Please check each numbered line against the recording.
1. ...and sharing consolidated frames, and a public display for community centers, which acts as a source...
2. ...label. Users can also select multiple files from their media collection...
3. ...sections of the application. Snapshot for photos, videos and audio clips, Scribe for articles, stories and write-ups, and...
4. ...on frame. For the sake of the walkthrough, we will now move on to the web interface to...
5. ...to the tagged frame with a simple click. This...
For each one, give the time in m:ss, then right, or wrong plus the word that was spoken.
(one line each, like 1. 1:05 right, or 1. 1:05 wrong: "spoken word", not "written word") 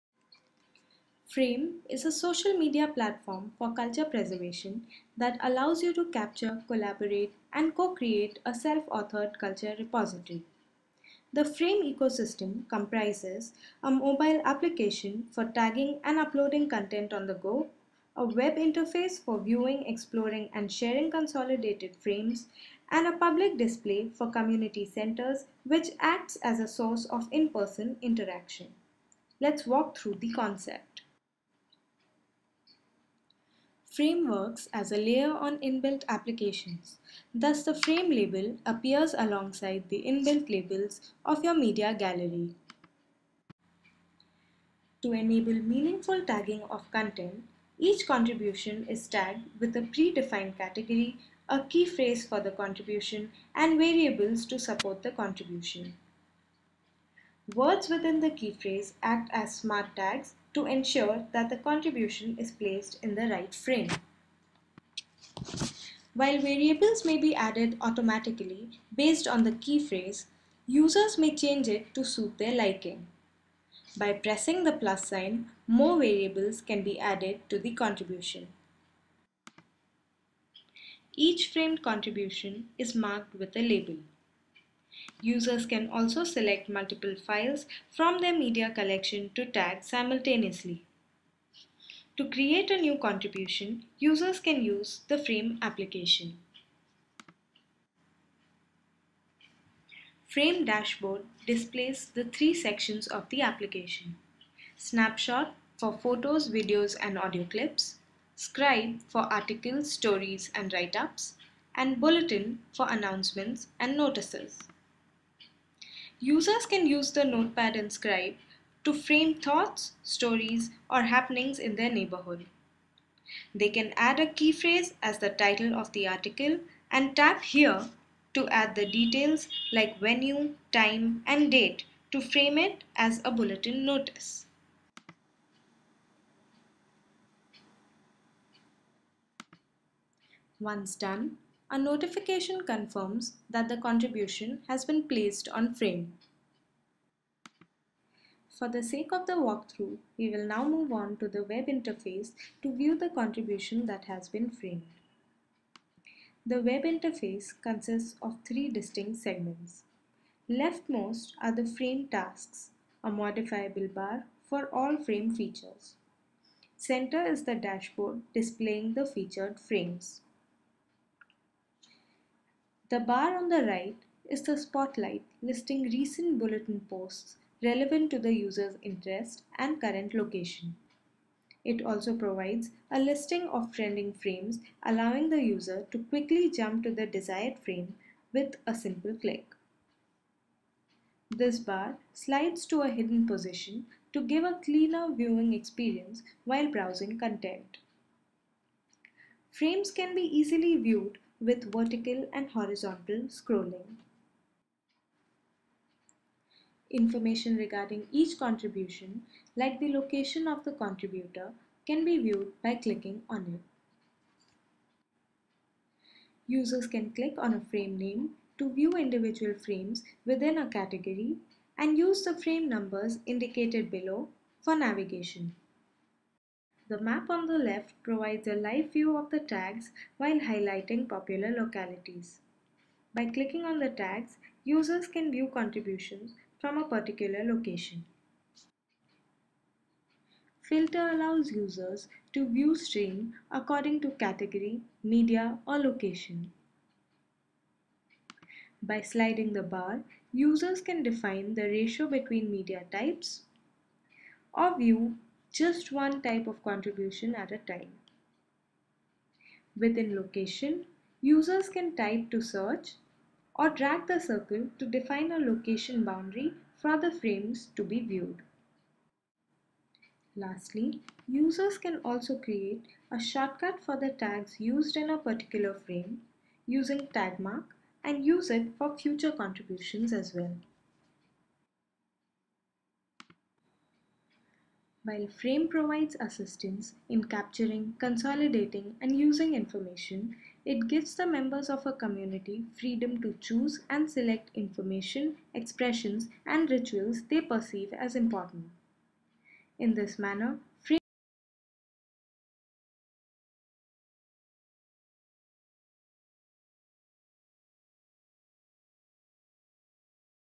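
1. 0:20 right
2. 1:23 right
3. 1:42 right
4. 2:25 right
5. 3:06 wrong: "desired", not "tagged".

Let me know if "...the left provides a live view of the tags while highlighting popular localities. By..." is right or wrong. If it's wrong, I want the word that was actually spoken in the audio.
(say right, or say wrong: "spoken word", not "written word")
right.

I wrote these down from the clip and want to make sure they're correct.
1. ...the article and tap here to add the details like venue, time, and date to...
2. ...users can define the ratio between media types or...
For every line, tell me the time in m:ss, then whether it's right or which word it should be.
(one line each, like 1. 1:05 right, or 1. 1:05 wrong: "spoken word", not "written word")
1. 2:05 right
2. 4:10 right.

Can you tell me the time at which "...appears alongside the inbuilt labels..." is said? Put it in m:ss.
0:38.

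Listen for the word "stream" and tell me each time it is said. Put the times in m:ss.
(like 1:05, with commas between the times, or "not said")
4:02.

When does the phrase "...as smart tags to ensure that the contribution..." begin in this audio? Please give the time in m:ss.
0:59.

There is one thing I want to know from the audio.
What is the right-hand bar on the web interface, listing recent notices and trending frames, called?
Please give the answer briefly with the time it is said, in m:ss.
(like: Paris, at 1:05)
spotlight, at 2:54.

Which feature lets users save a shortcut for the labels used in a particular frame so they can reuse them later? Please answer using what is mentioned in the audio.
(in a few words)
tag mark.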